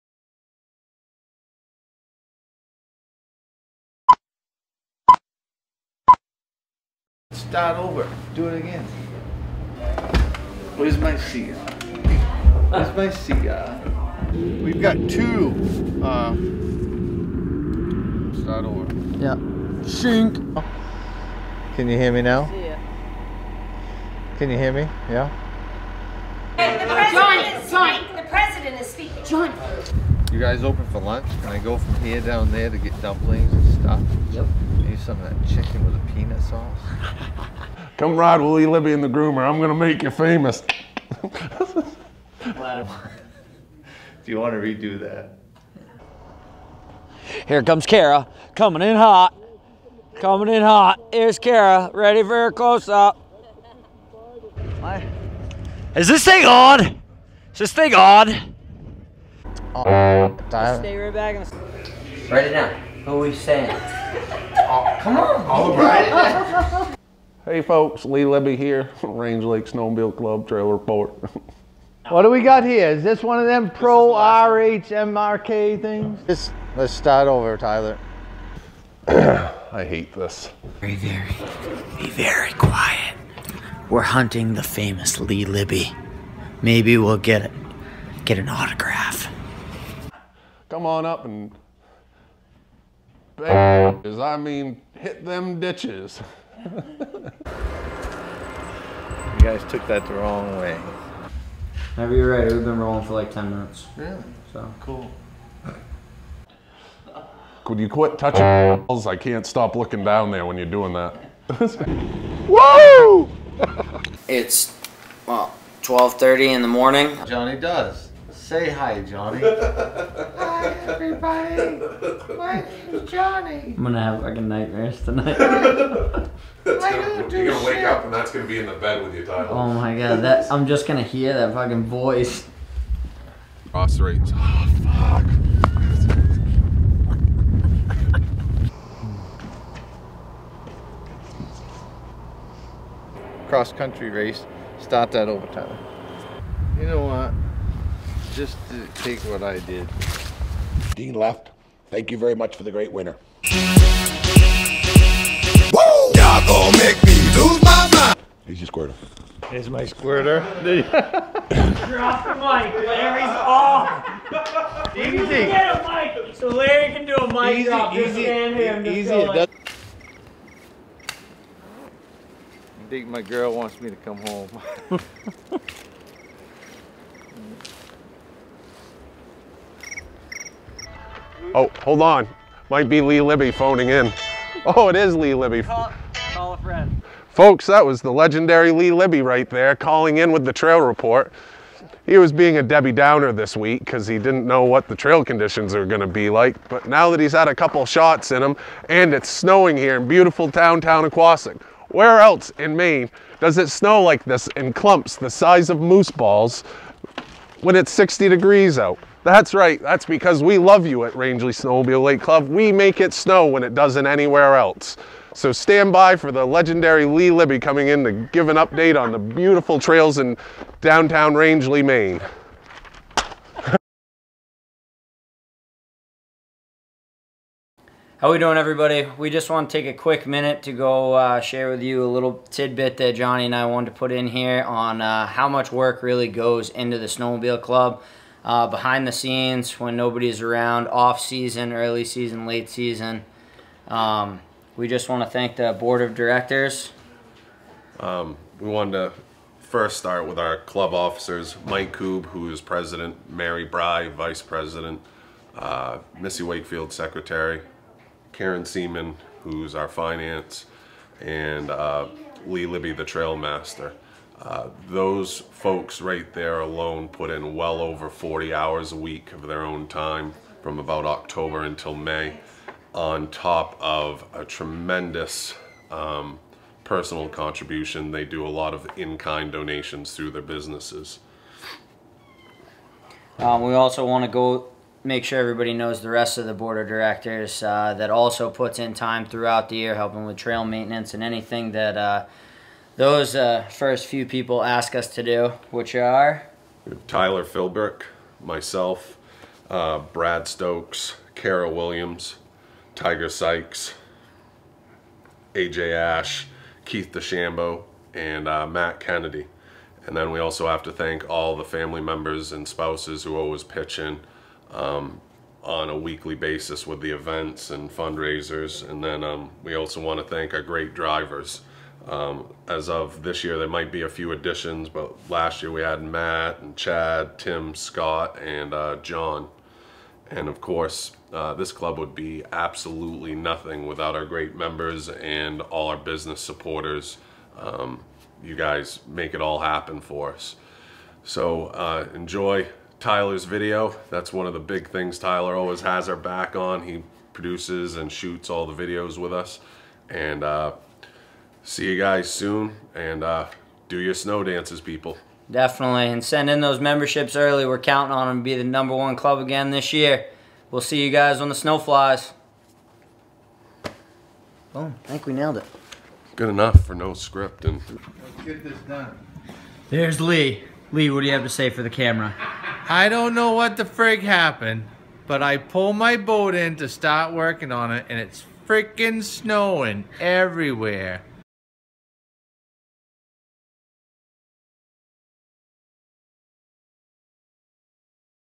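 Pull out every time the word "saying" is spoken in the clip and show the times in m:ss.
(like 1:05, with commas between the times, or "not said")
1:03.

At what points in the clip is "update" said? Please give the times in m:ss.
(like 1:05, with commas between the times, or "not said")
3:38.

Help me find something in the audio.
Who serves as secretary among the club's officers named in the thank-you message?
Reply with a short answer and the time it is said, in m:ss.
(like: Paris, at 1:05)
Missy Wakefield, at 4:16.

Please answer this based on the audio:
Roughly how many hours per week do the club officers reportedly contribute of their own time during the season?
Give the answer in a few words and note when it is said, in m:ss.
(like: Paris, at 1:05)
over 40 hours, at 4:27.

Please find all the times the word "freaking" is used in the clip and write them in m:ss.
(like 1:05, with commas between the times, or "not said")
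6:18.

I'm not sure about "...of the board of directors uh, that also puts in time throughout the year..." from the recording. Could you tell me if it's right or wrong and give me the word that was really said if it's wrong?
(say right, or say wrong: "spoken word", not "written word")
right.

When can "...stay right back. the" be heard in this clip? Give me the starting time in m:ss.
1:00.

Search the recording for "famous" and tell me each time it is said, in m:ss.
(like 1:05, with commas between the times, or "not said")
0:40, 1:24.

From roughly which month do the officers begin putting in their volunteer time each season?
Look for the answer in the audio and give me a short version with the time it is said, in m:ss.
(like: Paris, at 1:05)
October, at 4:31.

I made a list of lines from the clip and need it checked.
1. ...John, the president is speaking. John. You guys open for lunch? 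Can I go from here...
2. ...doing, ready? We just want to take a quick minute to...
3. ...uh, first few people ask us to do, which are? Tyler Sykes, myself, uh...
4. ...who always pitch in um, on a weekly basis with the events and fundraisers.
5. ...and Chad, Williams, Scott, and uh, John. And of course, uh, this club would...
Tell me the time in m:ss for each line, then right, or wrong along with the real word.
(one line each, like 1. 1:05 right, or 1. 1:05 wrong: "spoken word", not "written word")
1. 0:27 right
2. 3:48 wrong: "everybody", not "ready"
3. 4:53 wrong: "Philbrick", not "Sykes"
4. 5:13 right
5. 5:26 wrong: "Tim", not "Williams".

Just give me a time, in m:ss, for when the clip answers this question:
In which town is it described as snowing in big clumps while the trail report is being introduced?
3:21.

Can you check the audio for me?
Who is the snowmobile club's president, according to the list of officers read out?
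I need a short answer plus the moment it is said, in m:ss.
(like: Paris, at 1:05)
Mike Coob, at 4:11.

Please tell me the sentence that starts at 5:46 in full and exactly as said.
He produces and shoots all the videos with us.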